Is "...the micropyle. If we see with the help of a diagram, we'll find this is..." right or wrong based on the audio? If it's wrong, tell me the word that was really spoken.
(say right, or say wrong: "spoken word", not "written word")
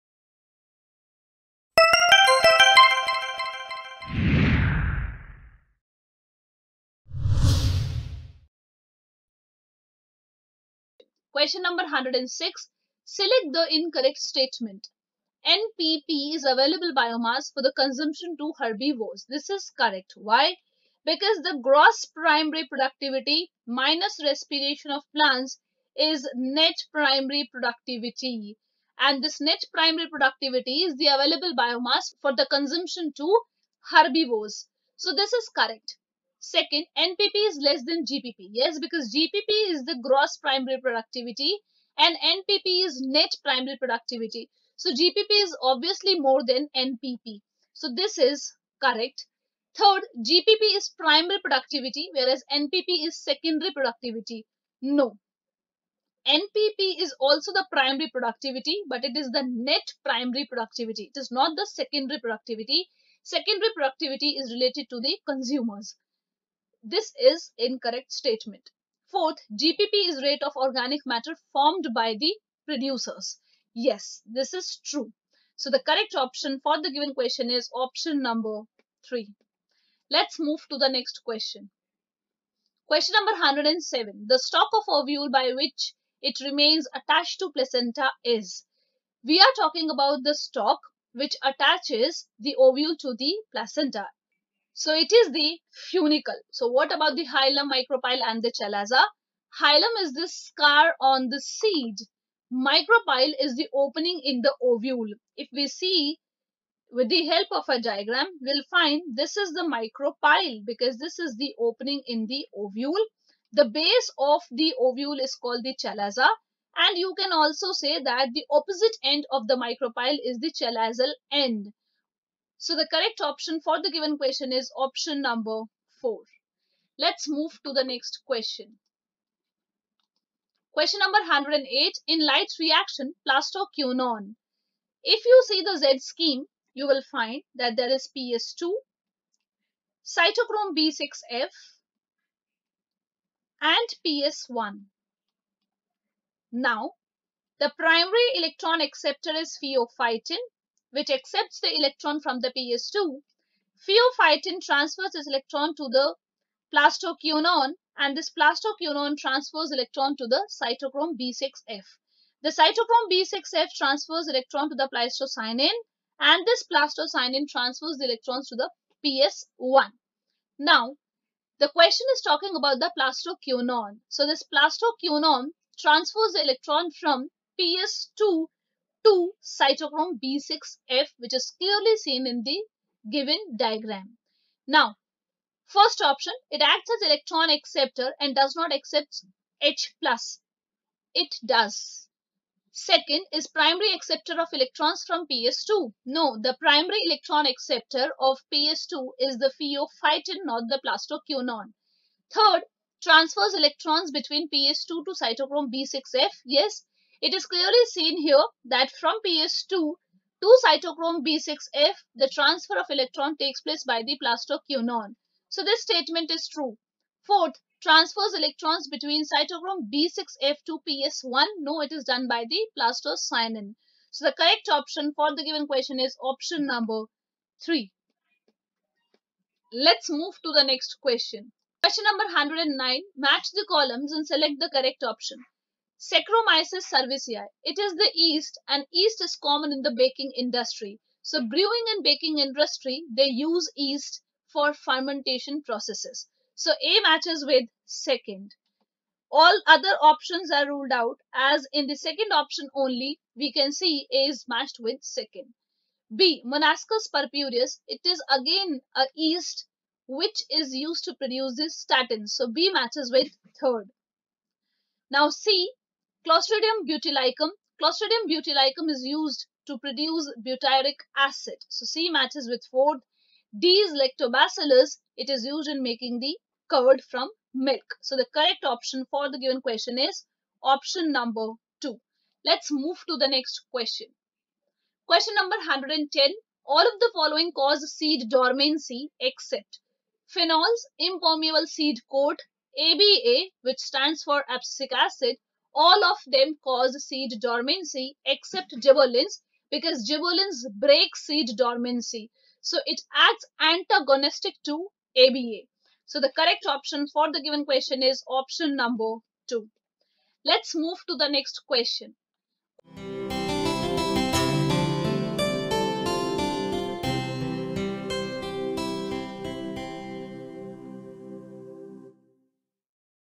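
wrong: "ovule", not "micropyle".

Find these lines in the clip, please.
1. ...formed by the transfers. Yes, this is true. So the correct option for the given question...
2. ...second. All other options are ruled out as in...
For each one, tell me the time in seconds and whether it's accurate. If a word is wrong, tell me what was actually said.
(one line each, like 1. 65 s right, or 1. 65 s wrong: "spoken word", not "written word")
1. 71 s wrong: "producers", not "transfers"
2. 247 s right.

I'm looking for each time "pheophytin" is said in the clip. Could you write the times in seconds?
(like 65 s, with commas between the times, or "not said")
149 s, 153 s, 199 s.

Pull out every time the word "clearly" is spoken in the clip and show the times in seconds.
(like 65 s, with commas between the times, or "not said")
181 s, 207 s.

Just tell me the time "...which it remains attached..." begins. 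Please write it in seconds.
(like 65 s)
85 s.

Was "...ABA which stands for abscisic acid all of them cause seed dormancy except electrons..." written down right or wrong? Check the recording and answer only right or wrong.
wrong.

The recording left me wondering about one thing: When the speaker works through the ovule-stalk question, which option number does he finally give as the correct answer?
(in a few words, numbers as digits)
4.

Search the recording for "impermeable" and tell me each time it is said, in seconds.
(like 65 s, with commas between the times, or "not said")
290 s.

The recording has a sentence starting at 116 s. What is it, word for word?
And you can also say that the opposite end of the micropyle is the chalazal end.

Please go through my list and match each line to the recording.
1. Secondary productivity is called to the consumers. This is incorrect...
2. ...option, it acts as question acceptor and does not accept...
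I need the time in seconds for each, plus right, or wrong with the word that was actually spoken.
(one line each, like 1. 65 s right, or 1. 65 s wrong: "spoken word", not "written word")
1. 63 s wrong: "related", not "called"
2. 186 s wrong: "electron", not "question".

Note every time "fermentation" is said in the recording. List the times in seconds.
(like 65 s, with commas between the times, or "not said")
244 s.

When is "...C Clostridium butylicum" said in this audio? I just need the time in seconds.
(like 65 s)
265 s.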